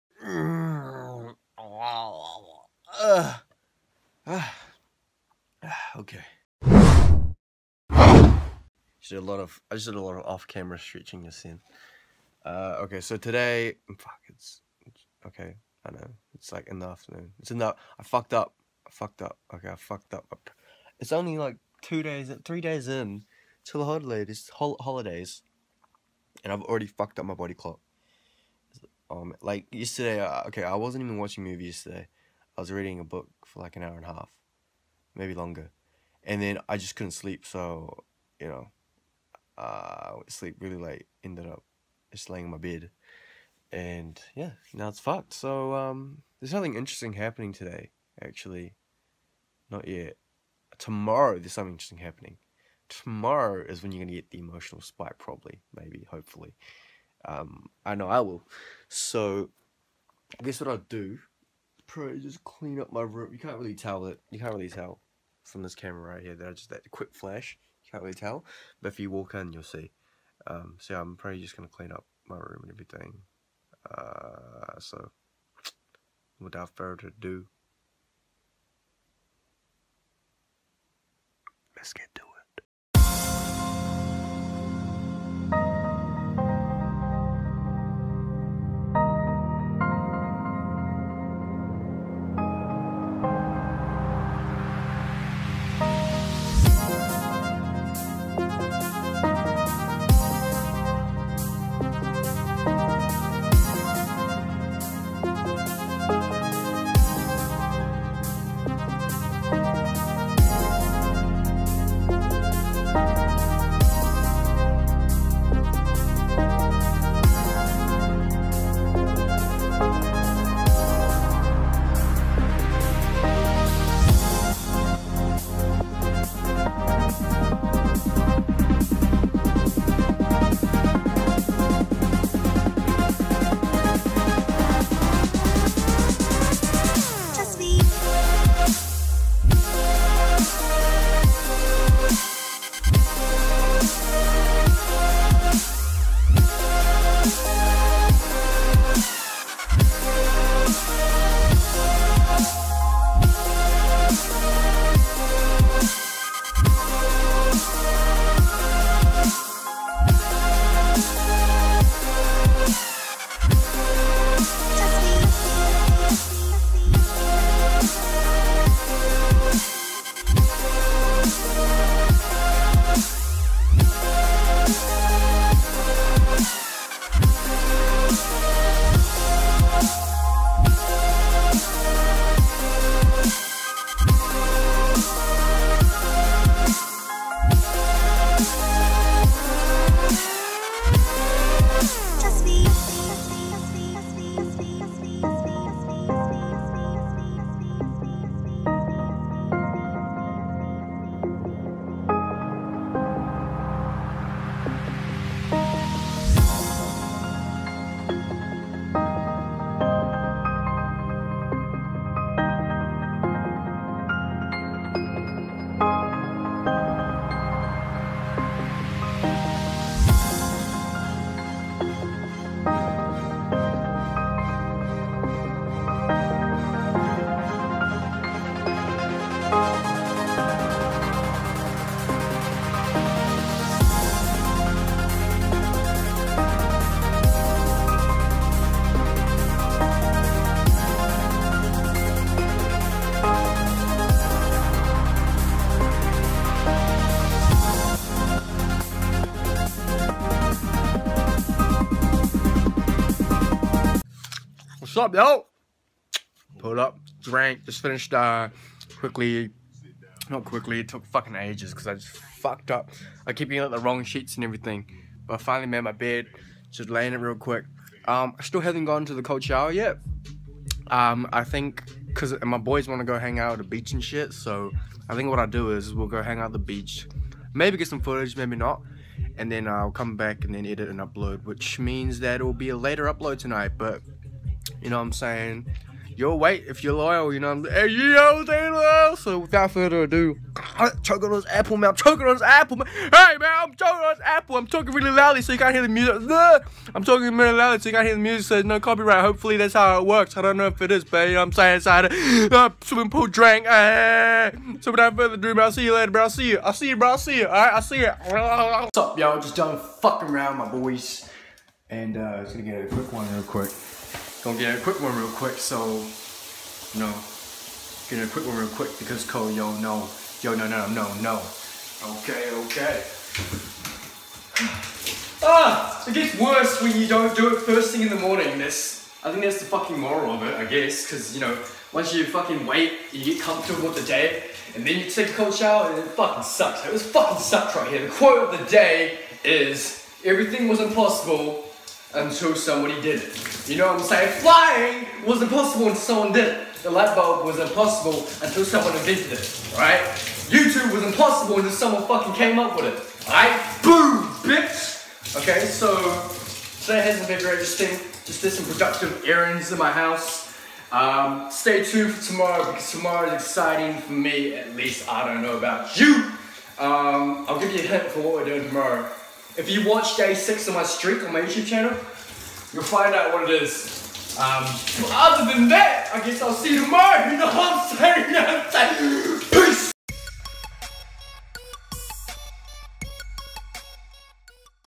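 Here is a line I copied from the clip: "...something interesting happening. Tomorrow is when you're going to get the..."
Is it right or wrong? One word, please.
right.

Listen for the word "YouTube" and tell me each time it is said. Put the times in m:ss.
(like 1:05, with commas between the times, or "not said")
5:50, 6:11.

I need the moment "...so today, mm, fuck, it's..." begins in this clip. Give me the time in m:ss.
0:13.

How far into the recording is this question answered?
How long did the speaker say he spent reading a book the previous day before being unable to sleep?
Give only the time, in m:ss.
0:33.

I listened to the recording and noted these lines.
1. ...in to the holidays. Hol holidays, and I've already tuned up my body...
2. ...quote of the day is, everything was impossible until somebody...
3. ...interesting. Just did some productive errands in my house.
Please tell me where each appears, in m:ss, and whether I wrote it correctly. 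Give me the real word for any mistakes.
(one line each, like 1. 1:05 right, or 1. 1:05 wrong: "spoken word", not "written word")
1. 0:22 wrong: "fucked", not "tuned"
2. 5:38 right
3. 5:57 right.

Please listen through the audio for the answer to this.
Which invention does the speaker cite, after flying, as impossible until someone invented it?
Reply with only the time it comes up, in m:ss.
5:46.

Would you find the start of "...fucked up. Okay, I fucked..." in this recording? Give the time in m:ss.
0:18.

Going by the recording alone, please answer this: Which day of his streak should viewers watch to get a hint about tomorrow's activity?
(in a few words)
day 6.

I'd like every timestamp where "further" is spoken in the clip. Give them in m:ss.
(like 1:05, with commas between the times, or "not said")
1:16, 4:49, 5:05.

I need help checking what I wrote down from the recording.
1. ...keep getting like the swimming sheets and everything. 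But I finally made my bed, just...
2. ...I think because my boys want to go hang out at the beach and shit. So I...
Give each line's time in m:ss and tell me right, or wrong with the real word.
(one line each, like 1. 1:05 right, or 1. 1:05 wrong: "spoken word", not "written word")
1. 4:23 wrong: "wrong", not "swimming"
2. 4:31 right.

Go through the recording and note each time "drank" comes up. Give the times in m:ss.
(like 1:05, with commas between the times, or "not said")
4:17, 5:03.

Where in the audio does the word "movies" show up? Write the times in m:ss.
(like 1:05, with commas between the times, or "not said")
0:31.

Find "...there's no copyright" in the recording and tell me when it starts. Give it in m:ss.
4:58.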